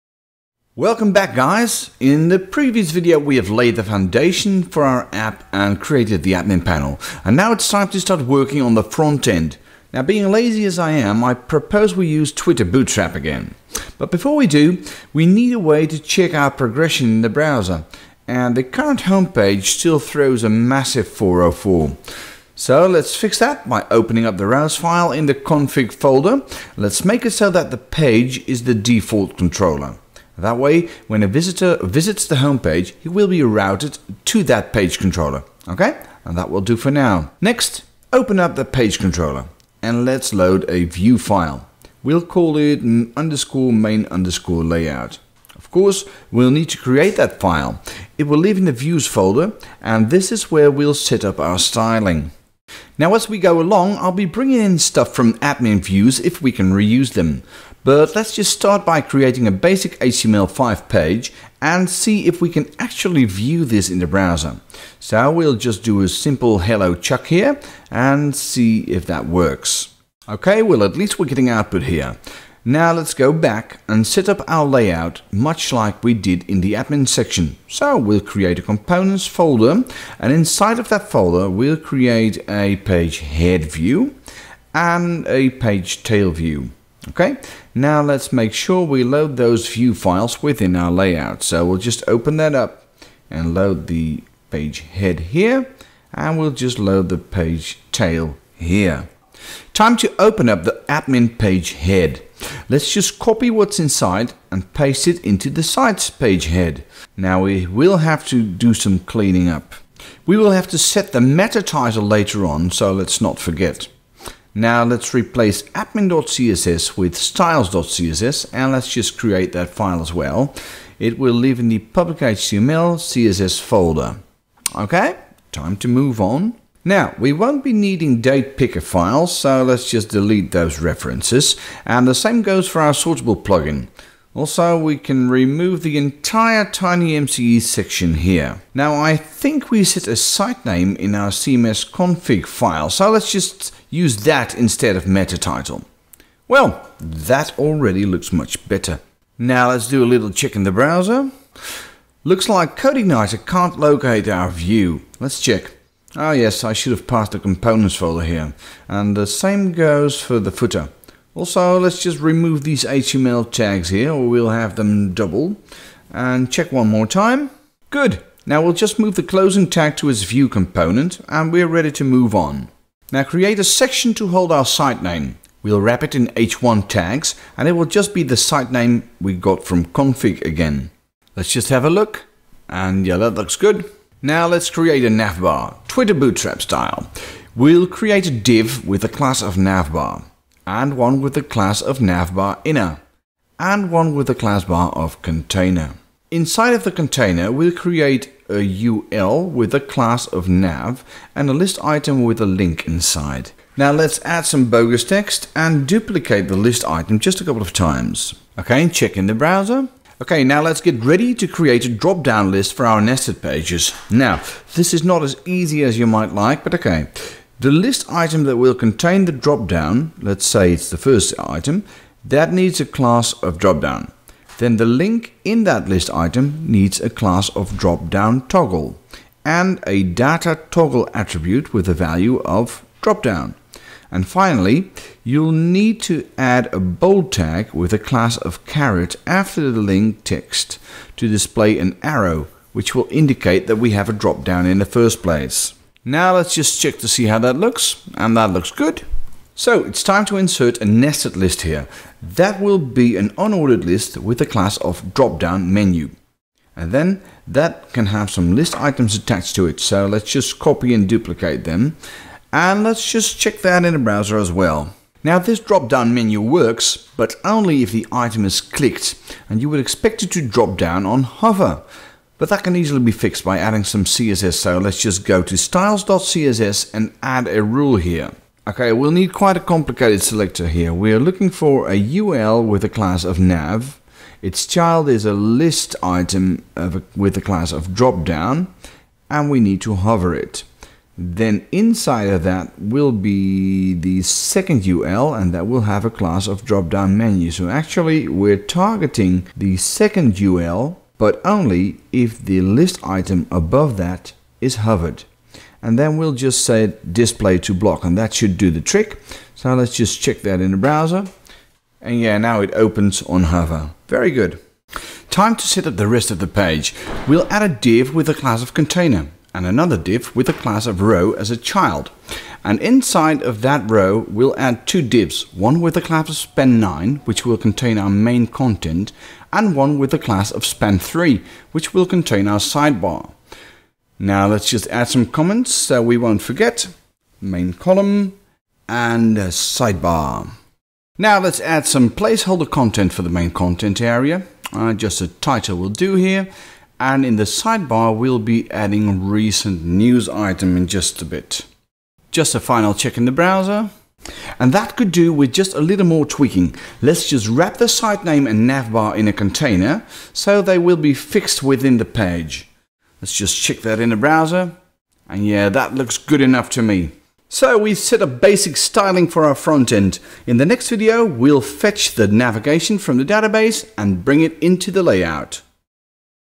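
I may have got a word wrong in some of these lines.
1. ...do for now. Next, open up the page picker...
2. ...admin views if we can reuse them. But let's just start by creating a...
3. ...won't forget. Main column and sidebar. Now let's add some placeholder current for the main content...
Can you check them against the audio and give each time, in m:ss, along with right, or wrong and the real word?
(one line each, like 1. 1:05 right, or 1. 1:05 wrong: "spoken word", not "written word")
1. 0:36 wrong: "controller", not "picker"
2. 0:55 right
3. 5:36 wrong: "content", not "current".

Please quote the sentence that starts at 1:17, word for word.
So we'll create a components folder and inside of that folder we'll create a page head view and a page tail view.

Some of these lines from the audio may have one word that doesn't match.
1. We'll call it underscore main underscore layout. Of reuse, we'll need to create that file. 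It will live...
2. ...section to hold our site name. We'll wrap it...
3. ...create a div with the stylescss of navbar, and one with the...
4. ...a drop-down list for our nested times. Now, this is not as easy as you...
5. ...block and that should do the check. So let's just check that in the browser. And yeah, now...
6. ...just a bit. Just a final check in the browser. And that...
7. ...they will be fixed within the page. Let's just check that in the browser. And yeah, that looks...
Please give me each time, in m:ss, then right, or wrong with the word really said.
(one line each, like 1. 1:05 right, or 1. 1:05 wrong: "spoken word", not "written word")
1. 0:42 wrong: "course", not "reuse"
2. 2:53 right
3. 3:07 wrong: "class", not "stylescss"
4. 3:31 wrong: "pages", not "times"
5. 5:07 wrong: "trick", not "check"
6. 5:50 right
7. 6:00 right.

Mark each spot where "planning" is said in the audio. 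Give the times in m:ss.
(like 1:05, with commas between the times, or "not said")
not said.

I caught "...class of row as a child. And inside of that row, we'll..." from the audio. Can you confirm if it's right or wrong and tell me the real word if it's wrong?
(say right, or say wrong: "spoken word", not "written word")
right.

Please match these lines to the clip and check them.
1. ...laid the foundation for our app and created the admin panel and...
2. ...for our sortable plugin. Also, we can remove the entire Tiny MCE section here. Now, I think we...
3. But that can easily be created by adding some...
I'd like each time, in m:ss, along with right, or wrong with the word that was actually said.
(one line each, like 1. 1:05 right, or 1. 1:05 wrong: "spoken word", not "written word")
1. 0:03 right
2. 2:12 right
3. 4:32 wrong: "fixed", not "created".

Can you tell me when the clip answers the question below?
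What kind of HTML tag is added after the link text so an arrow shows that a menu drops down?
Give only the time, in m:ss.
3:56.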